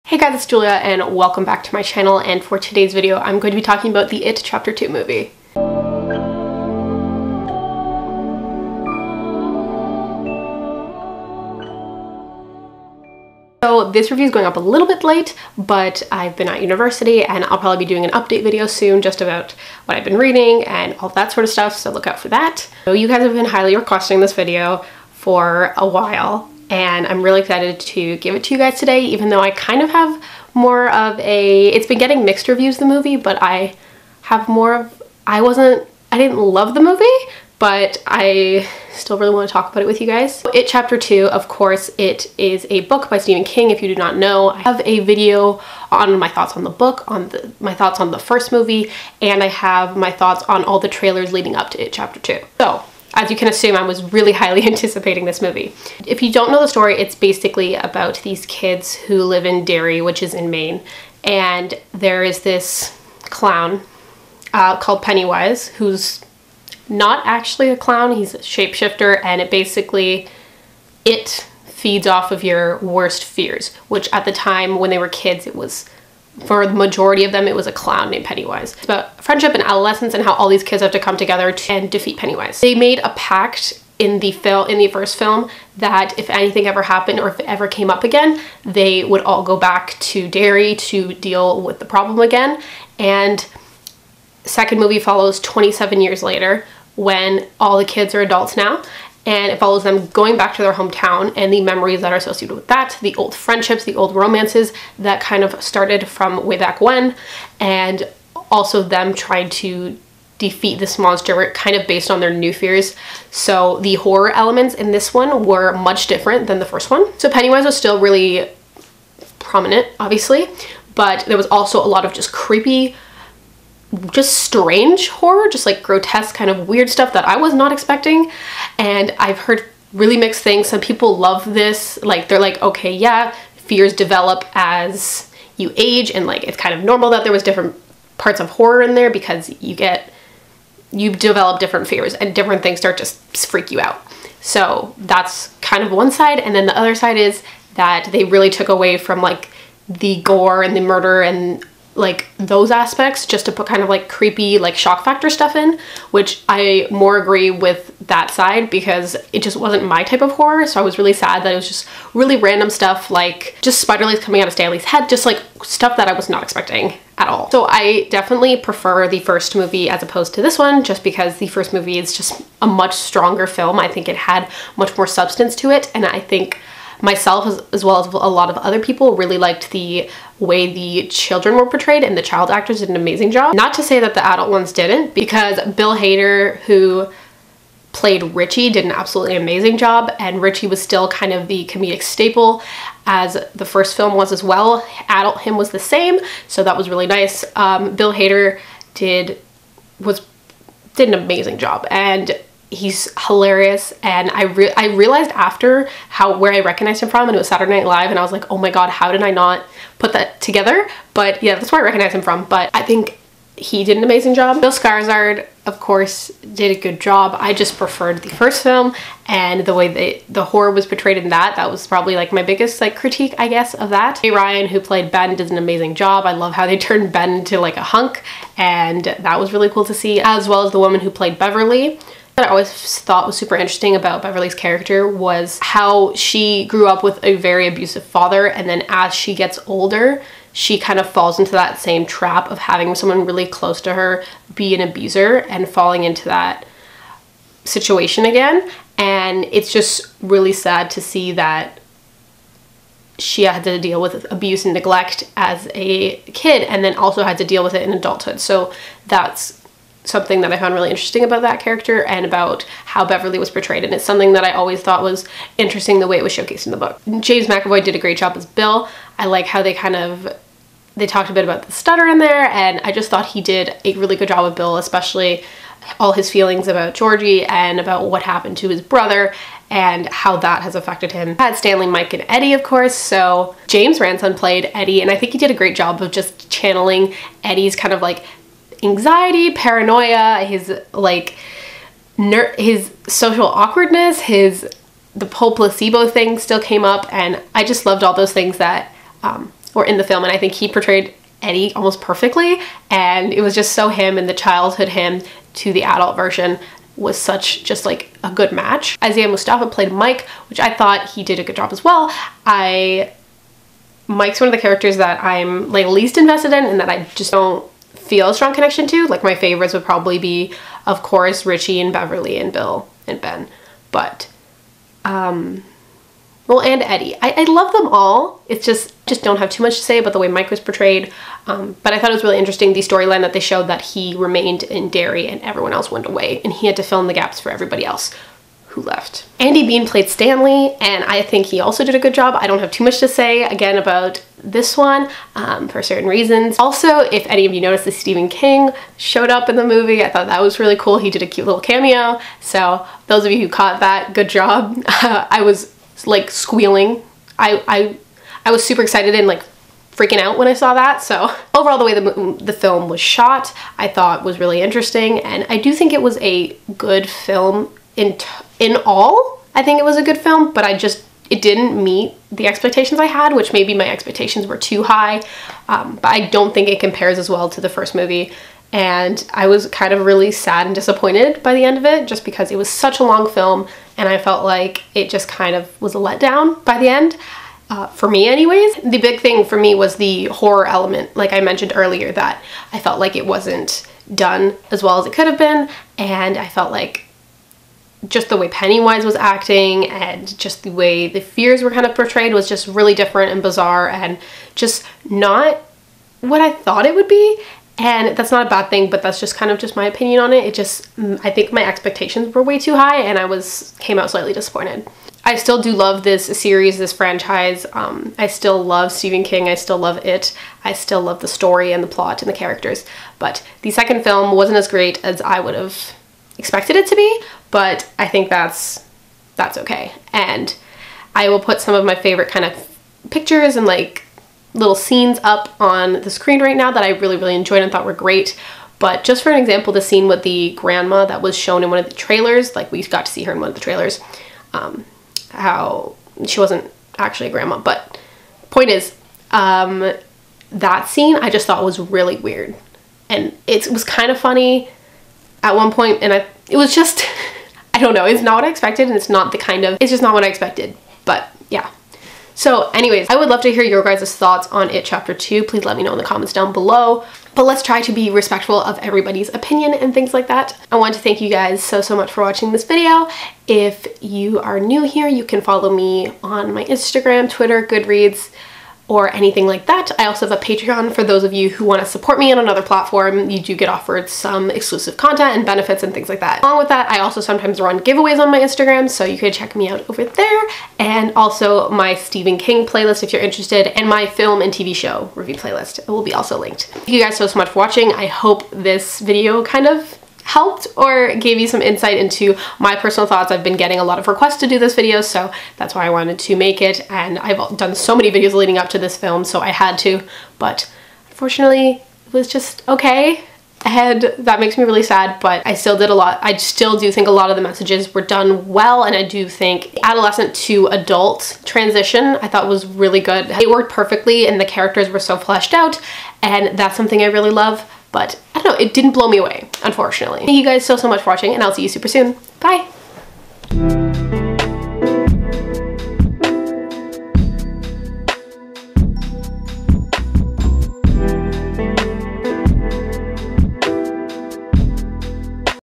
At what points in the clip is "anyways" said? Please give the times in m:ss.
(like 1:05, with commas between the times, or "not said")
6:28, 7:42.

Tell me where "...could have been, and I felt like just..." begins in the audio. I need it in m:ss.
6:35.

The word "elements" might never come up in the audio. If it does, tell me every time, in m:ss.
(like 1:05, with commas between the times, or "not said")
1:54, 6:30.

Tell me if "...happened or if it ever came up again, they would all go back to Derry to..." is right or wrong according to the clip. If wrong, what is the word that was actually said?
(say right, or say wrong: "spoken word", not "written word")
right.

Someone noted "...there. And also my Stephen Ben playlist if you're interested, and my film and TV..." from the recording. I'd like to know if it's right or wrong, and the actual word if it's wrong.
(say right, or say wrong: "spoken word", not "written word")
wrong: "King", not "Ben".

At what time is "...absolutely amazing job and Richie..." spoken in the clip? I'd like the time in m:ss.
3:08.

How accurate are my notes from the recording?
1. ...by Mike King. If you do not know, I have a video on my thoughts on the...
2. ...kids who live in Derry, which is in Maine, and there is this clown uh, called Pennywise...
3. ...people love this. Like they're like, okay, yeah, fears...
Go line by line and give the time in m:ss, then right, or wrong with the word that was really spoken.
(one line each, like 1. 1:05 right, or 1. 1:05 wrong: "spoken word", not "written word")
1. 0:43 wrong: "Stephen", not "Mike"
2. 0:58 right
3. 2:10 right.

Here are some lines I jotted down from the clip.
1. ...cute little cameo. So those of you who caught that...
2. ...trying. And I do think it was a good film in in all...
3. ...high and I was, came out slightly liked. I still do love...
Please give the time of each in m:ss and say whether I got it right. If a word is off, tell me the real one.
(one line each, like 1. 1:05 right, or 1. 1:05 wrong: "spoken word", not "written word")
1. 5:51 right
2. 6:04 wrong: "interesting", not "trying"
3. 6:52 wrong: "disappointed", not "liked".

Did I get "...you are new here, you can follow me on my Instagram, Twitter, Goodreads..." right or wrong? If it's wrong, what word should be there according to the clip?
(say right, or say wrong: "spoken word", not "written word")
right.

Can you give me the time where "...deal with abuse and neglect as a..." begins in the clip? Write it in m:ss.
4:13.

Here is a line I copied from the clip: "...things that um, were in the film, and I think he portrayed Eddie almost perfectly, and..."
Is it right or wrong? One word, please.
right.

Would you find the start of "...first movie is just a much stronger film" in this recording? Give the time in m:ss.
2:51.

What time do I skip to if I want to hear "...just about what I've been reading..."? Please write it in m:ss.
0:19.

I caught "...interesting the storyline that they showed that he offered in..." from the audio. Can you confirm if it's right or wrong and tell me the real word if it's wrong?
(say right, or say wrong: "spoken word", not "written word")
wrong: "remained", not "offered".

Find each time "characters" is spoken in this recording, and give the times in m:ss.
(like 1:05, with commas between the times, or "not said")
3:54, 4:21, 5:14, 7:02, 8:44.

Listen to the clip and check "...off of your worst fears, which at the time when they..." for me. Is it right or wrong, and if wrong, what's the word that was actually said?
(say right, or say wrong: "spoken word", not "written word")
right.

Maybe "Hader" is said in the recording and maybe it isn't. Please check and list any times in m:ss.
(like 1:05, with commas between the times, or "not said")
3:05, 3:18.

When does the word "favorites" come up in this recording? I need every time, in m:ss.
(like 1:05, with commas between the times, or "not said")
5:19, 7:11.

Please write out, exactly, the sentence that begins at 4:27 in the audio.
James McAvoy did a great job as Bill.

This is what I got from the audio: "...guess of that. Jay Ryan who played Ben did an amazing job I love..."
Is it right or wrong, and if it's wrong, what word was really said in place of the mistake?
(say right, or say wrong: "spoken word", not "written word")
right.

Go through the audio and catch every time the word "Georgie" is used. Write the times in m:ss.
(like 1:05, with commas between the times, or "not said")
4:36.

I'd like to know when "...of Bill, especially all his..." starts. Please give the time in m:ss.
4:34.